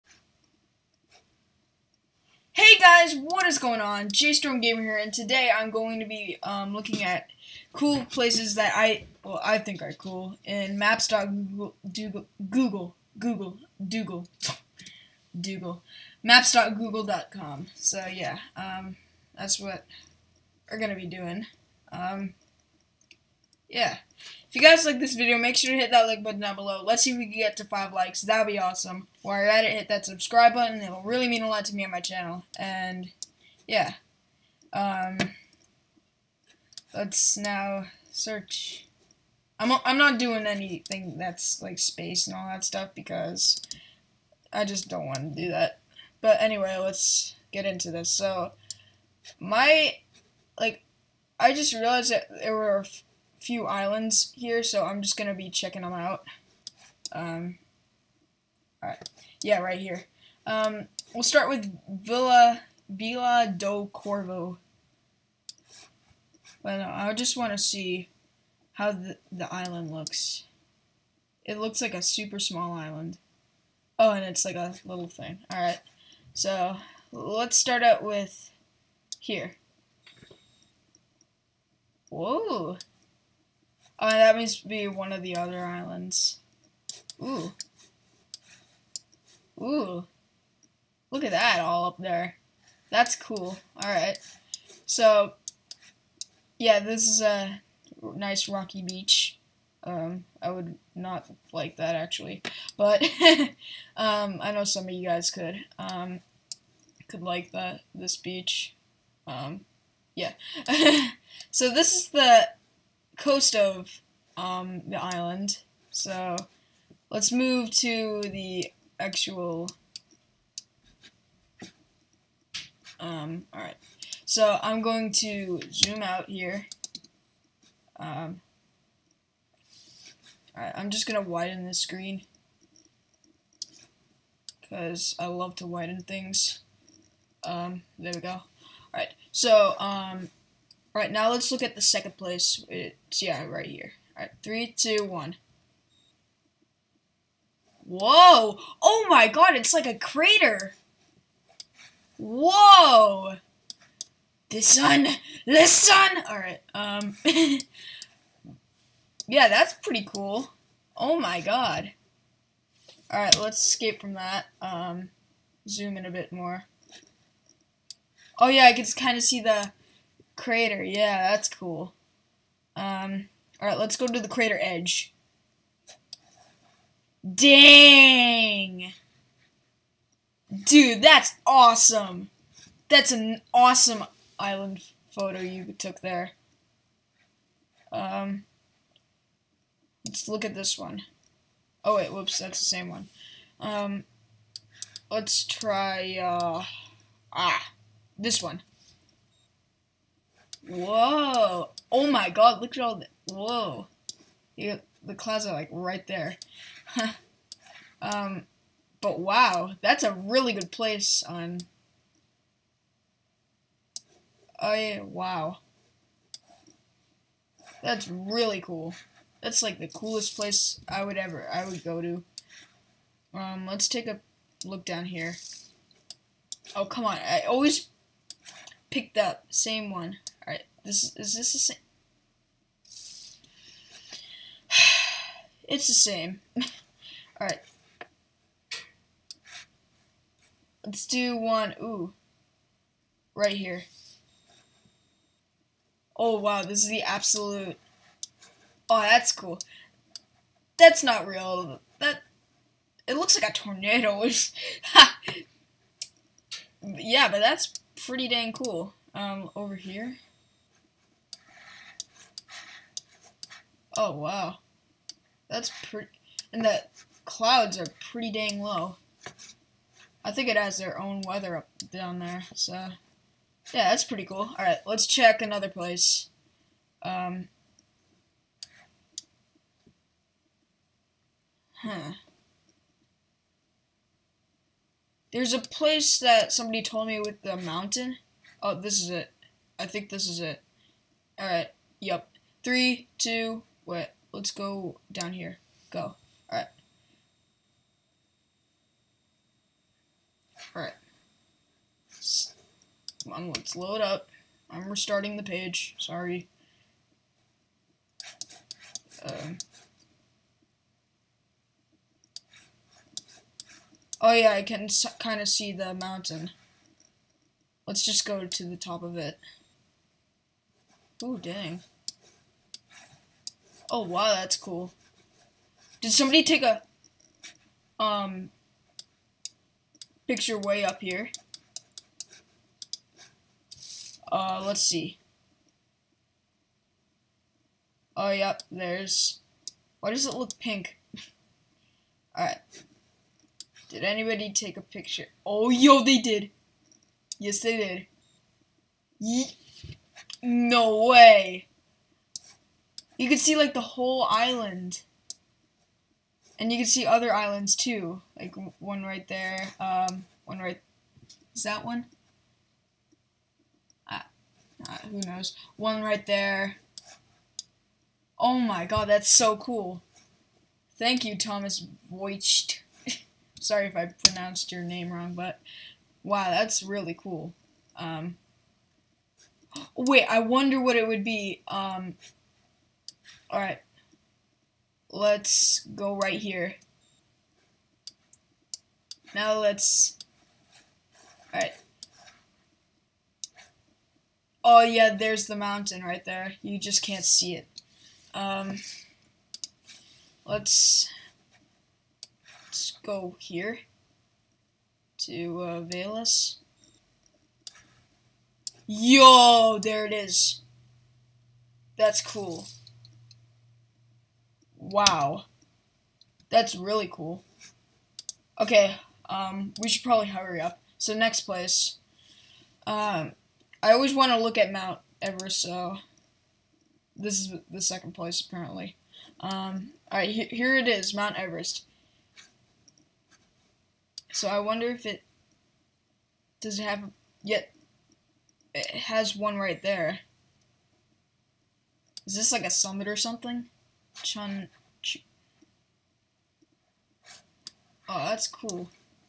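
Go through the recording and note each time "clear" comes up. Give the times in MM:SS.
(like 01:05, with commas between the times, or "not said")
not said.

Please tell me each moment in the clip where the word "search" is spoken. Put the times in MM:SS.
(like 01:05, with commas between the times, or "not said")
00:38.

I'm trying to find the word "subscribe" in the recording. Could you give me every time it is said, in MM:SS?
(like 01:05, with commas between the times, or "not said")
00:30.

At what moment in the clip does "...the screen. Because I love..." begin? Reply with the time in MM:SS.
02:11.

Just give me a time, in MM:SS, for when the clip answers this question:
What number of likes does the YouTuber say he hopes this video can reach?
00:27.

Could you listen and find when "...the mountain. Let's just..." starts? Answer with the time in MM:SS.
05:15.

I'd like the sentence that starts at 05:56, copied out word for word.
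And you could see other islands too, like one right there, um, one right, is that one?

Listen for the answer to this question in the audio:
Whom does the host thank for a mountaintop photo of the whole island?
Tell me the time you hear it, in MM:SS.
06:11.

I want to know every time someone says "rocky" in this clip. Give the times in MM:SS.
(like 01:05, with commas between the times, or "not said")
01:38.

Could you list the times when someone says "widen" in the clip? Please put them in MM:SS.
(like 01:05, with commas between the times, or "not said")
02:11, 02:15.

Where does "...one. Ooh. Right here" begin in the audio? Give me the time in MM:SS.
04:01.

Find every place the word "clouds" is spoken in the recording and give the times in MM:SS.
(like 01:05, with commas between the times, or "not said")
03:25, 04:27.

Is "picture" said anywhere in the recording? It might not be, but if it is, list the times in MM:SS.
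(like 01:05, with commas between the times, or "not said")
05:30, 05:44.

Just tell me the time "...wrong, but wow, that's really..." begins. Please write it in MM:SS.
06:15.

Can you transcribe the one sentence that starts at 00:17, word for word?
So yeah, um, that's what we're gonna be doing.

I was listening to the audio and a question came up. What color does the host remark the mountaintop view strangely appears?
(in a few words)
Pink.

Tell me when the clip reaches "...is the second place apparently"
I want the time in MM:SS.
07:07.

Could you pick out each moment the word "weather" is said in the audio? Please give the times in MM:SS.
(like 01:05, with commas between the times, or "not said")
04:31.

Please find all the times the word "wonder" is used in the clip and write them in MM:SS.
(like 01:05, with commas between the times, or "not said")
06:20, 07:14.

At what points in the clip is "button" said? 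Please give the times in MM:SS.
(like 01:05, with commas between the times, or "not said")
00:26, 00:30.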